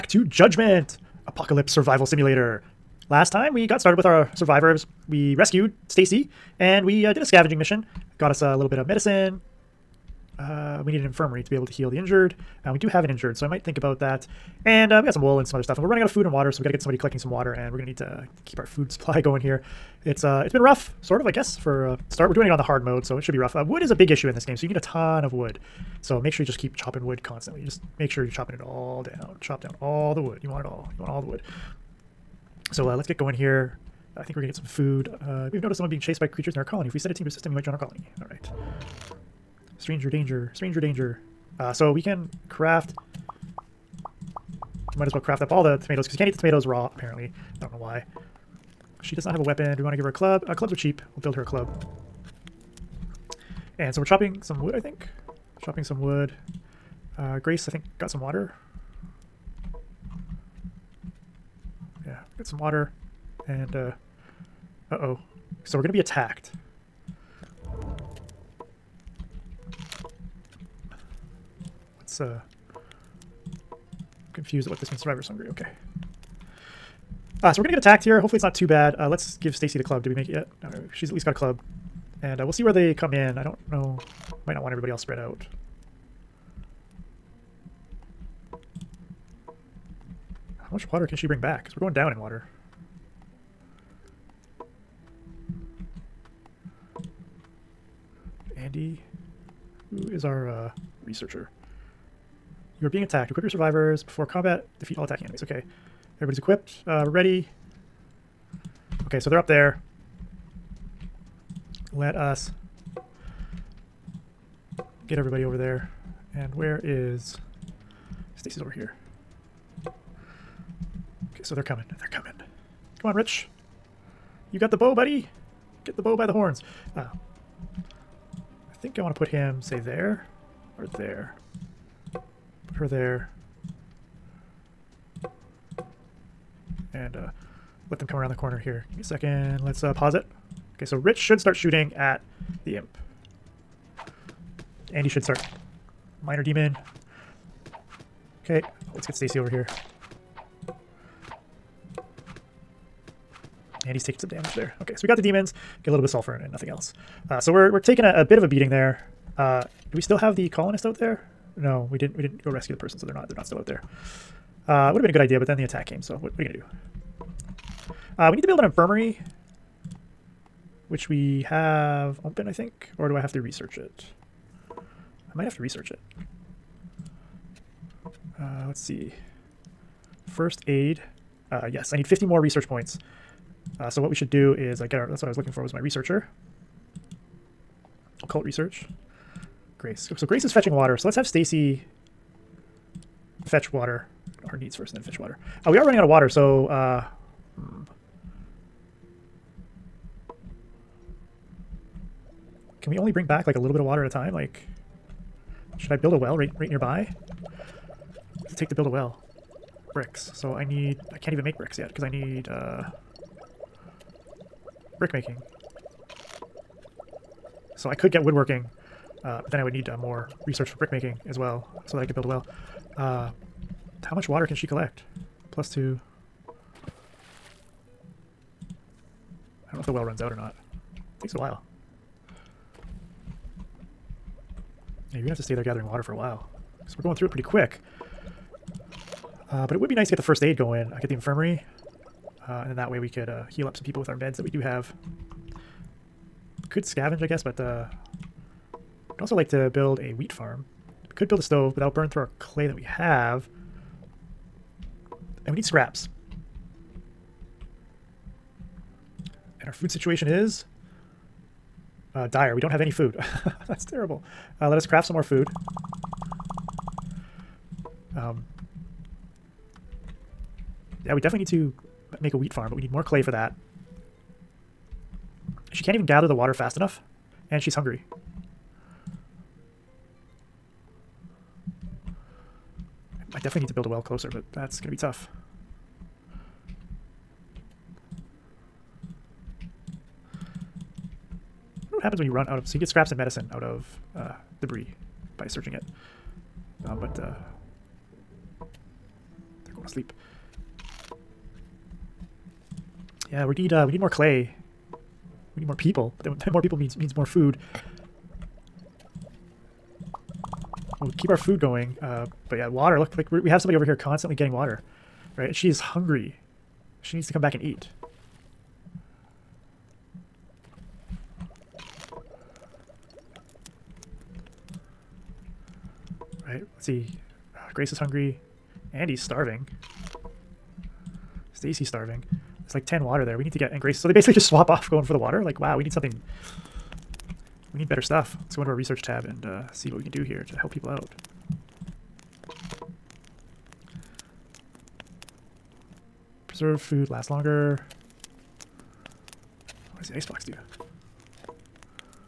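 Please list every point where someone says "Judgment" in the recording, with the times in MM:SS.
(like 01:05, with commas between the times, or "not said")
00:00.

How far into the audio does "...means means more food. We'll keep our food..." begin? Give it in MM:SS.
05:06.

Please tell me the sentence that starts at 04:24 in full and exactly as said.
Uh, let us craft some more food.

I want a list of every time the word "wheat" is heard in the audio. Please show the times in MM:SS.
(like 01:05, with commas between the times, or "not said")
04:10, 04:32.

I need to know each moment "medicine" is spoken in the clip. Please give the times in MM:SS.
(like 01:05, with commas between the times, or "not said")
00:08, 04:53.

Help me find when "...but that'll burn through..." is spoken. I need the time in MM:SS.
04:11.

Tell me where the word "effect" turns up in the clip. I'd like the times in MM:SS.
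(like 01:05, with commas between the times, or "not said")
not said.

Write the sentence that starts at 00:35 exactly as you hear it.
Uh, we've noticed someone being chased by creatures in our colony.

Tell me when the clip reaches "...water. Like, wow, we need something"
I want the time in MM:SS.
05:35.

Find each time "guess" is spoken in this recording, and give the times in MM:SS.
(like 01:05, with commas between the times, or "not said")
00:21, 04:07.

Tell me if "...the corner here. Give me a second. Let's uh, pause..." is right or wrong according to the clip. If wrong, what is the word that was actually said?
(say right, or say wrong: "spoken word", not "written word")
right.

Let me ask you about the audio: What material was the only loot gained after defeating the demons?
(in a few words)
Sulfur.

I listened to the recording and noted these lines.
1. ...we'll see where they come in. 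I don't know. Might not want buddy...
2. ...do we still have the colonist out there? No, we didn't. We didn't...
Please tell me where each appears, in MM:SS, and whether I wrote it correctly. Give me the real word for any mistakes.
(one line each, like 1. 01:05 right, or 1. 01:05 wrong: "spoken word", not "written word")
1. 01:22 wrong: "everybody", not "buddy"
2. 02:39 right.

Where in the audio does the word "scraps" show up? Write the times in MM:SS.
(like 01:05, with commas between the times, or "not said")
04:15, 04:52.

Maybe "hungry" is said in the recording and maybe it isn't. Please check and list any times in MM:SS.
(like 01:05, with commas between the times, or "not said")
01:15, 04:37, 05:15, 05:27.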